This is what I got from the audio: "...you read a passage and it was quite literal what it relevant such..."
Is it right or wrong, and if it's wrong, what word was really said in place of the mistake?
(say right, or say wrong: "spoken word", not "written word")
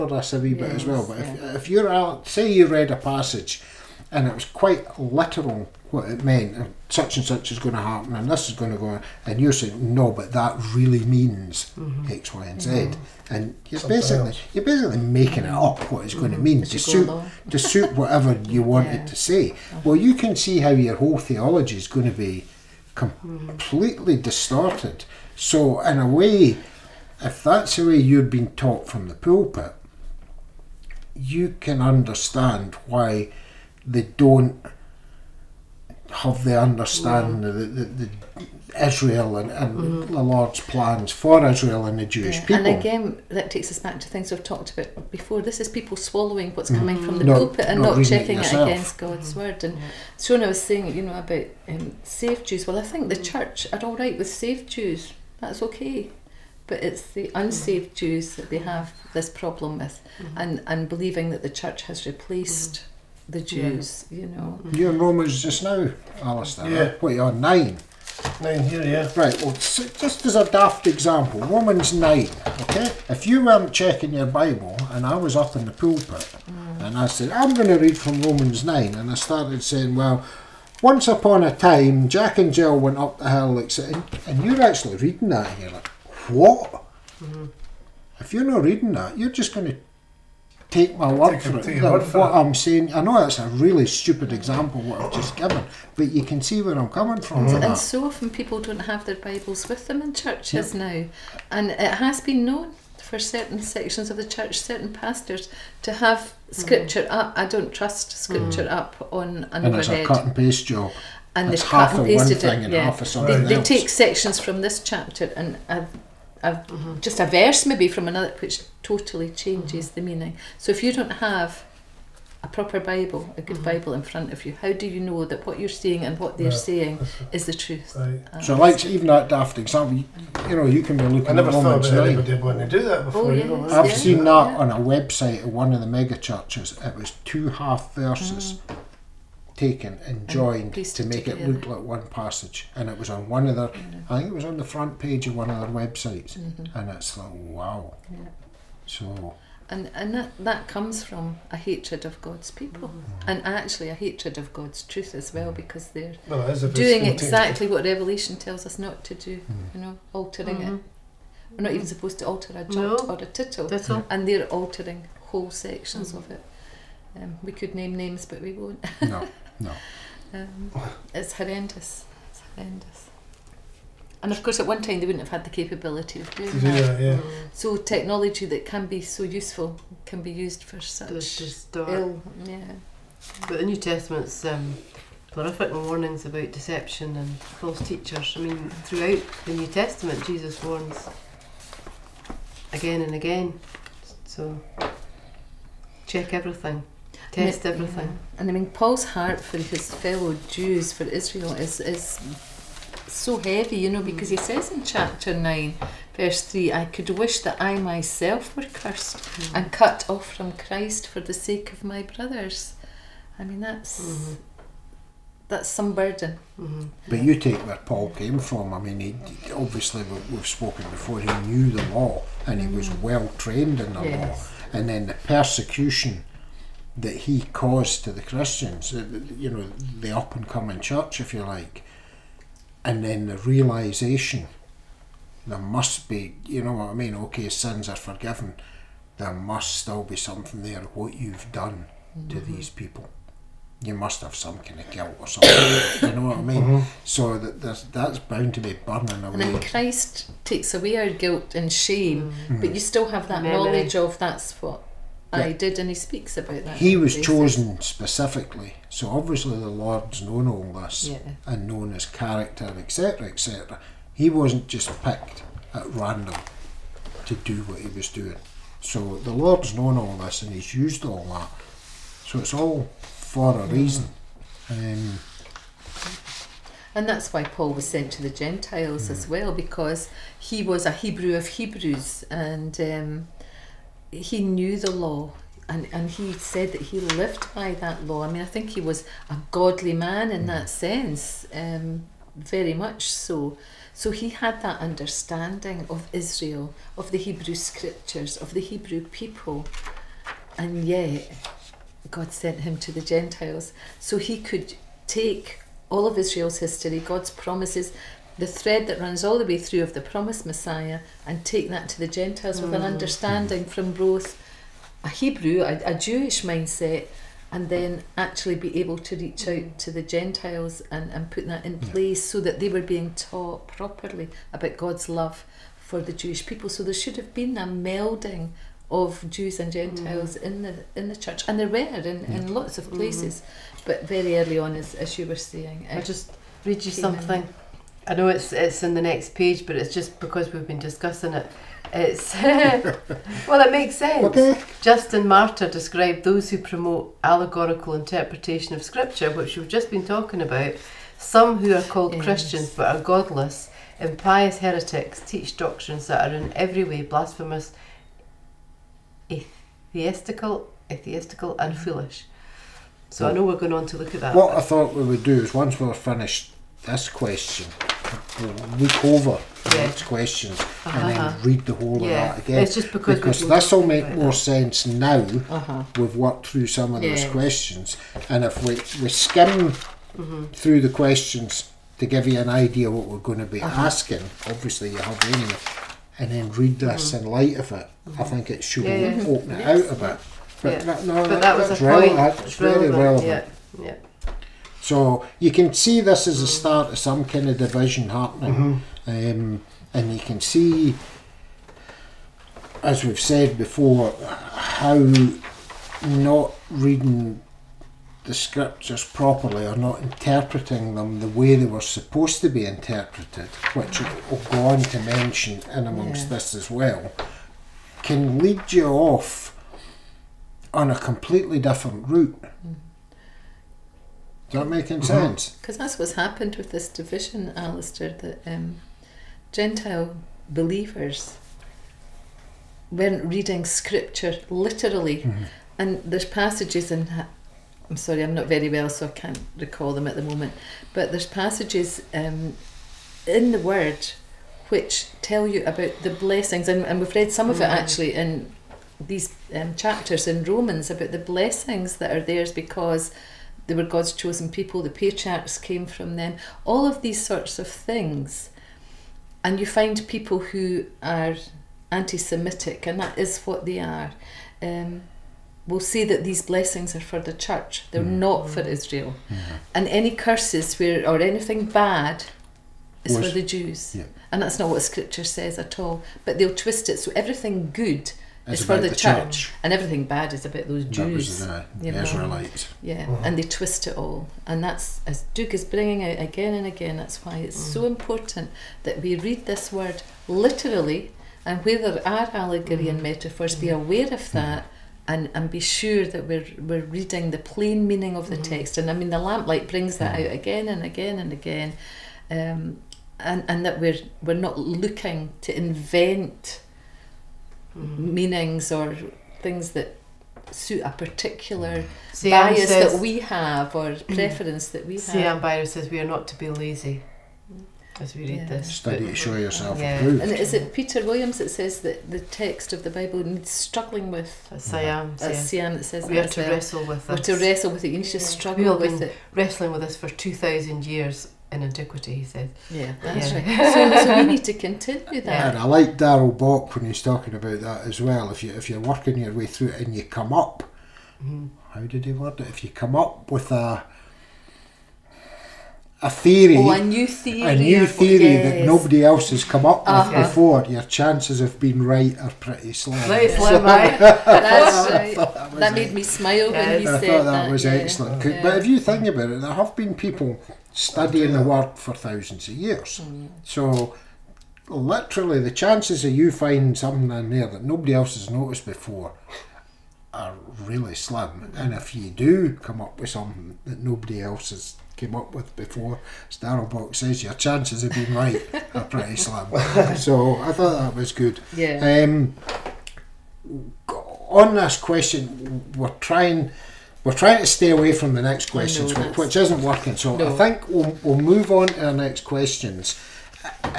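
wrong: "meant", not "relevant".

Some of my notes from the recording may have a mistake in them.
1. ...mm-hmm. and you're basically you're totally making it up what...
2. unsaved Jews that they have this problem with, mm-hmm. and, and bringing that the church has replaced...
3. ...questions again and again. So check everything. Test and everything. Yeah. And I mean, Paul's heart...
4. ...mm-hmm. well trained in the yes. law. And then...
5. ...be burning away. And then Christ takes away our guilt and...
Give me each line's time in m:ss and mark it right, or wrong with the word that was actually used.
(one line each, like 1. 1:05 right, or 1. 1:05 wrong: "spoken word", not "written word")
1. 0:12 wrong: "basically", not "totally"
2. 0:57 wrong: "believing", not "bringing"
3. 3:10 wrong: "warns", not "questions"
4. 3:42 right
5. 4:08 right.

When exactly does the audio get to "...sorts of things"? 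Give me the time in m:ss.
7:37.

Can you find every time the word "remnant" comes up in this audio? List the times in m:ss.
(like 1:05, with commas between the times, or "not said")
not said.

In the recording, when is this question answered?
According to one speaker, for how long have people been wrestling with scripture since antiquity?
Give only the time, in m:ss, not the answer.
8:50.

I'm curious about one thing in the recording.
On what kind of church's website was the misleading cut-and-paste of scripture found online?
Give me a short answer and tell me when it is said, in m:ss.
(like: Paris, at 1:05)
mega churches, at 2:15.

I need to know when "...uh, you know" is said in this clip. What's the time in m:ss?
8:01.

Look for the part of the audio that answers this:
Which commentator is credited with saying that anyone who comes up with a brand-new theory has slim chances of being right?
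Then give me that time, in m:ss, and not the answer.
8:55.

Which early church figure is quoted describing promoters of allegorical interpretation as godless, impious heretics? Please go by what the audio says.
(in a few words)
Justin Martyr.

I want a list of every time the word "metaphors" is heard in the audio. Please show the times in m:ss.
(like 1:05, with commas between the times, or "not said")
8:13.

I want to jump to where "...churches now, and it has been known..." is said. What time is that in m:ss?
1:40.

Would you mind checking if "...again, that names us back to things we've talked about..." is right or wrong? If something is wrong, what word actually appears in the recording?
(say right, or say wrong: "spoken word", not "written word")
wrong: "takes", not "names".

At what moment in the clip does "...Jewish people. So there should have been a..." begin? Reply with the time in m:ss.
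5:26.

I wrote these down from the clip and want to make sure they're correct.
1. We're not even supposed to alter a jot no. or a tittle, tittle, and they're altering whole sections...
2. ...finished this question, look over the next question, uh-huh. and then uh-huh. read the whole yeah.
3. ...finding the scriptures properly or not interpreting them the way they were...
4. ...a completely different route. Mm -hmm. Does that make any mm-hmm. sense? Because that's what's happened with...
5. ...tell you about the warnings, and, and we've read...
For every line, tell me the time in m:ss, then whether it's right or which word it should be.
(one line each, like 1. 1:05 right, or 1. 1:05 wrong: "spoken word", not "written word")
1. 2:41 right
2. 6:05 right
3. 6:46 wrong: "reading", not "finding"
4. 7:00 right
5. 7:25 wrong: "blessings", not "warnings".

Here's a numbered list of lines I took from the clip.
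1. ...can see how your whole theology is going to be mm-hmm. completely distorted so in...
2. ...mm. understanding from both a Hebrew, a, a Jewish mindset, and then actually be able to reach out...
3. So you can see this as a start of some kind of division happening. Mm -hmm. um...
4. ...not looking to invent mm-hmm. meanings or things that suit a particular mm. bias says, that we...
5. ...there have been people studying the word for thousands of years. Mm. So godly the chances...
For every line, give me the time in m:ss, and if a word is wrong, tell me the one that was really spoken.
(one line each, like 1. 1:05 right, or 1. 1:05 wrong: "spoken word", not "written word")
1. 0:20 right
2. 5:12 right
3. 6:34 right
4. 8:24 right
5. 9:19 wrong: "literally", not "godly".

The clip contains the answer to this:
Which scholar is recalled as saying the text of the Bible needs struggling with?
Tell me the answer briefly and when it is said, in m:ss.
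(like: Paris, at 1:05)
Peter Williams, at 8:40.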